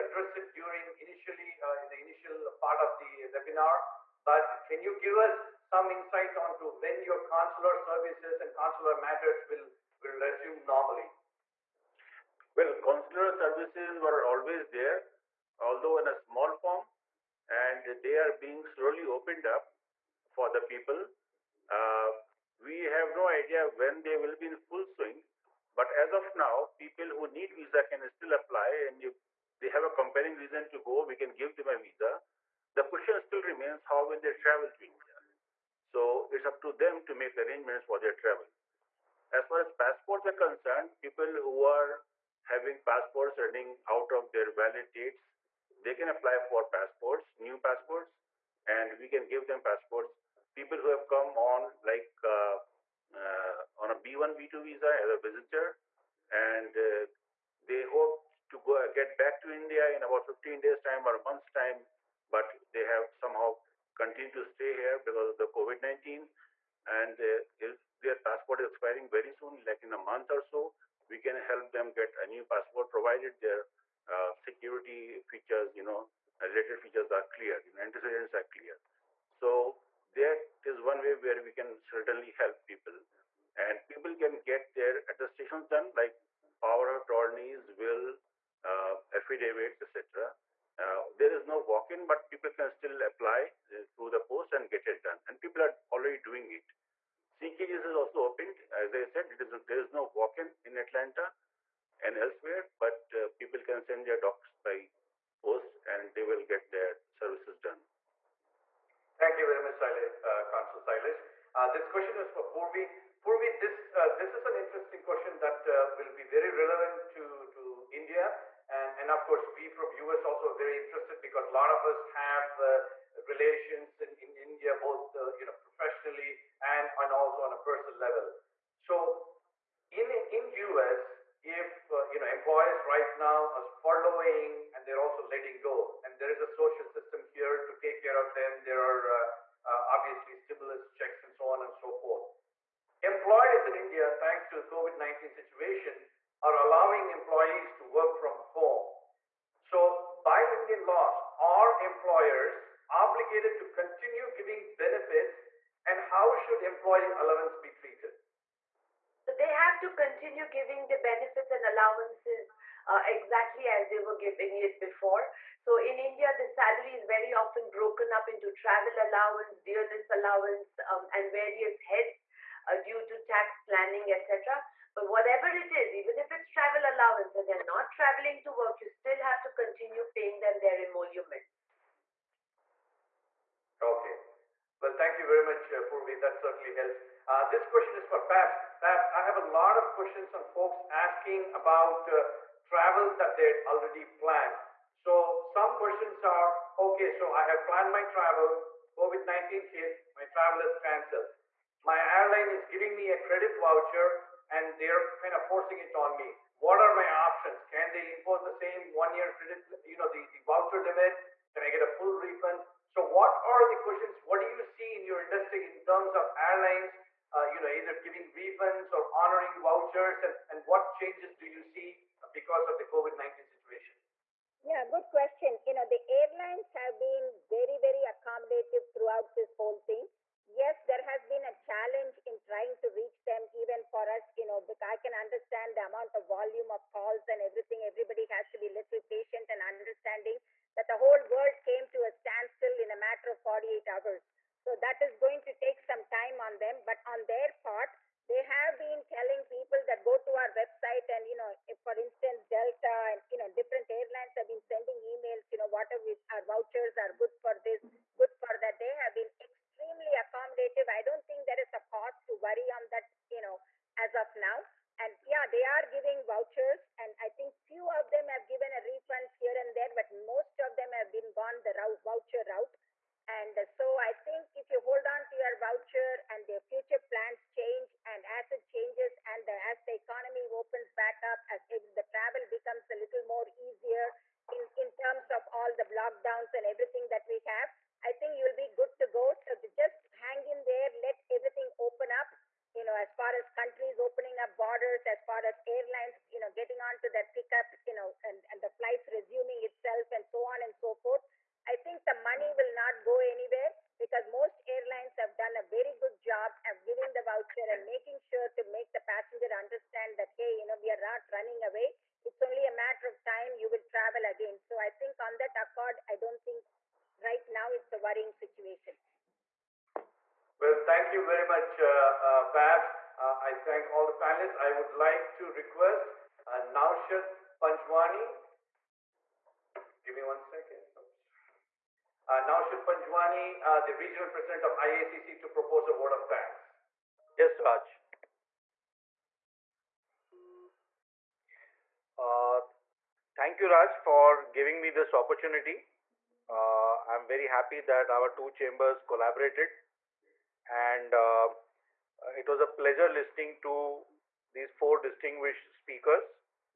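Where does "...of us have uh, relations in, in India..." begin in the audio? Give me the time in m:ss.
2:01.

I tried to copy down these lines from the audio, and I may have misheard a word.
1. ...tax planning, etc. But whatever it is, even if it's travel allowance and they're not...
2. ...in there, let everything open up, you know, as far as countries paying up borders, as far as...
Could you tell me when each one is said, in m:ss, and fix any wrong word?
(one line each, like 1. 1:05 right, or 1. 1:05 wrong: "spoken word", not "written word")
1. 2:53 right
2. 4:50 wrong: "opening", not "paying".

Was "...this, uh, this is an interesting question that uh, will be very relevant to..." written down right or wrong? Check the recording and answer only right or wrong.
right.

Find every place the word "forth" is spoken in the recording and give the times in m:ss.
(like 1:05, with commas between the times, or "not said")
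2:21, 5:01.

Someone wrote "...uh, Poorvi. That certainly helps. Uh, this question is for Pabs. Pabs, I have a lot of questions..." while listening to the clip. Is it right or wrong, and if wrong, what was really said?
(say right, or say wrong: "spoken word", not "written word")
right.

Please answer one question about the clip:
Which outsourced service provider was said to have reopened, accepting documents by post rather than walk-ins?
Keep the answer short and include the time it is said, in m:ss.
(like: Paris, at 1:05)
CKGS, at 1:37.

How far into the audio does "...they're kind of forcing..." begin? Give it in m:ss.
3:24.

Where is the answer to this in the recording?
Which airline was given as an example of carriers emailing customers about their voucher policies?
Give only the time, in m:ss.
4:12.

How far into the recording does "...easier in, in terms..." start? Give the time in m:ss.
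4:43.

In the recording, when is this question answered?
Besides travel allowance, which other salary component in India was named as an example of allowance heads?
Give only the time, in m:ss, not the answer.
2:49.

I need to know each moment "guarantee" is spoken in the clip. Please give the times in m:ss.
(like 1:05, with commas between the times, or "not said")
not said.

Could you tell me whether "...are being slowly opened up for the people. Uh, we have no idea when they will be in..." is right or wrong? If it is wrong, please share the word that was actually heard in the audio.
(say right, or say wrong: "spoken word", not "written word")
right.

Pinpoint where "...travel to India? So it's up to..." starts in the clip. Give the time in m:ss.
0:34.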